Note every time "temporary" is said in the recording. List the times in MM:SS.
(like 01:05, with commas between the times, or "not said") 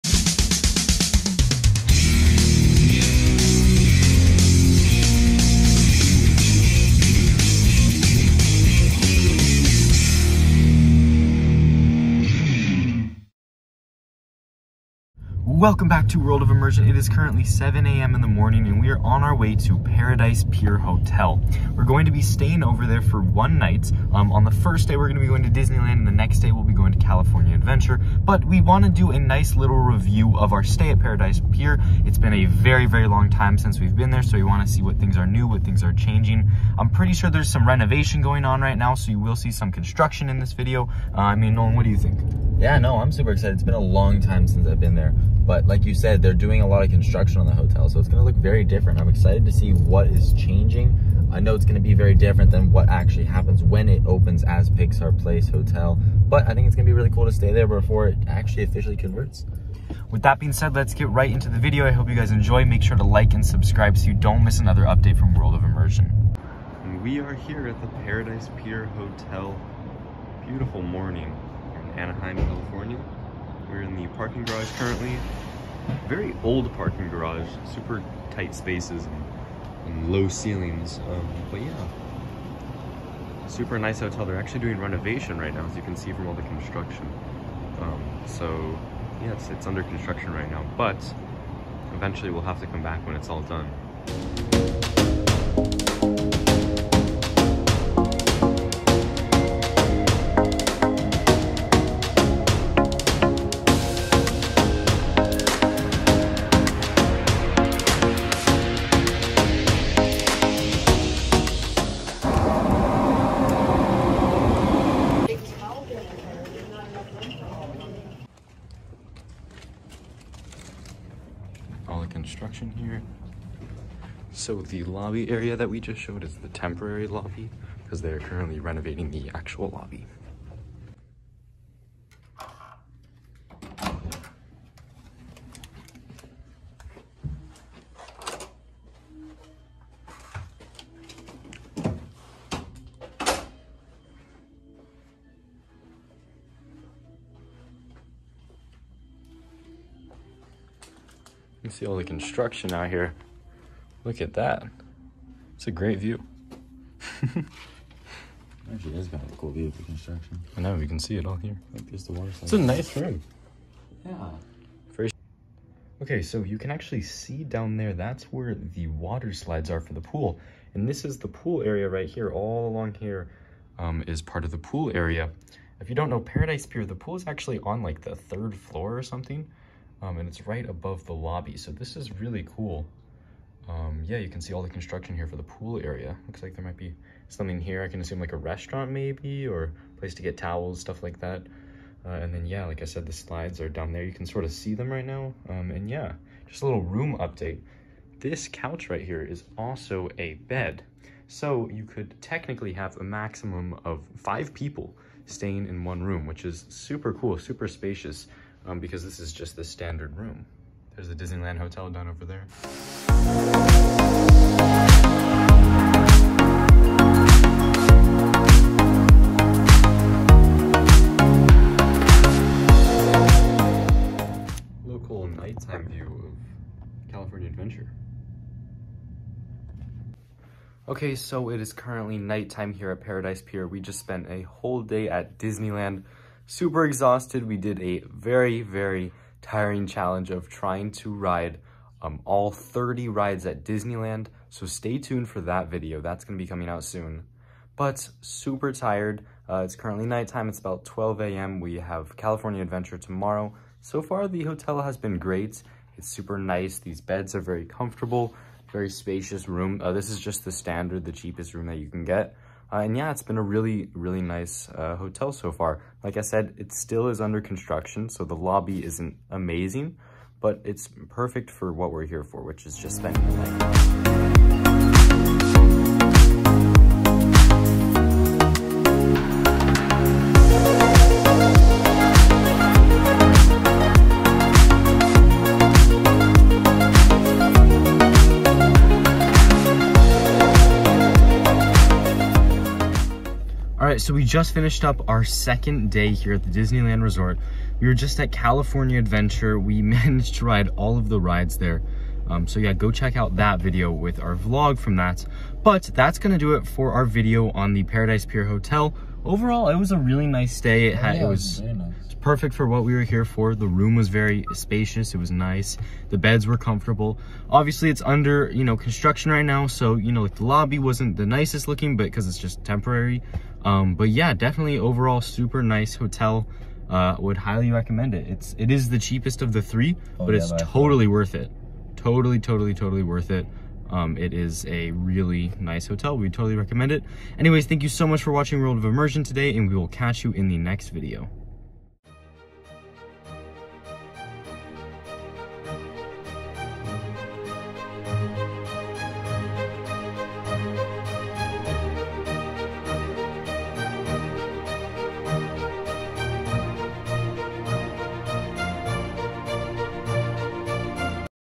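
02:06, 05:22.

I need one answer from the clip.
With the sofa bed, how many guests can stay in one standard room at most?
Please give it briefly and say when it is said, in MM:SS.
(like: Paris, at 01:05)
5, at 03:24.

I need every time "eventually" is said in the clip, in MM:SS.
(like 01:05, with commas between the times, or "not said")
01:31.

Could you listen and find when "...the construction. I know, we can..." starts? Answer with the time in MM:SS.
02:39.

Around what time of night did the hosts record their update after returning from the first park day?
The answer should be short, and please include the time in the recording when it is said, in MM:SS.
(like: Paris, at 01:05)
12 a.m., at 04:10.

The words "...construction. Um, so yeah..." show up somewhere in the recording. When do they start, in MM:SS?
01:26.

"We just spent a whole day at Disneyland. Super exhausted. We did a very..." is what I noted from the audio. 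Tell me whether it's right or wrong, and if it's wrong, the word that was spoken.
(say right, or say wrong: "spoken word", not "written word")
right.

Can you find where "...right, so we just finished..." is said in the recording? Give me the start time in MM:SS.
04:53.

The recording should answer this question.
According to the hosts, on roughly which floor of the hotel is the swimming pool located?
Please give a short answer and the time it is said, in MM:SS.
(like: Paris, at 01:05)
third floor, at 02:58.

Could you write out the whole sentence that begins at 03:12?
Uh, and then yeah, like I said, the slides are down there.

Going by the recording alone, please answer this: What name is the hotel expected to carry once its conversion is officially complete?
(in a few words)
Pixar Place Hotel.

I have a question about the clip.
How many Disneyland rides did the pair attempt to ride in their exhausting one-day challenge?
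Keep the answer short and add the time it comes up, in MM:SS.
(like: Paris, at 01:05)
30, at 04:02.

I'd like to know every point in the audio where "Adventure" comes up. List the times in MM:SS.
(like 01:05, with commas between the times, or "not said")
00:27, 03:47, 04:12, 04:58.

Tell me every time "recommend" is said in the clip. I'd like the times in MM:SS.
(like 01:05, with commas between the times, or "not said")
05:27, 05:36.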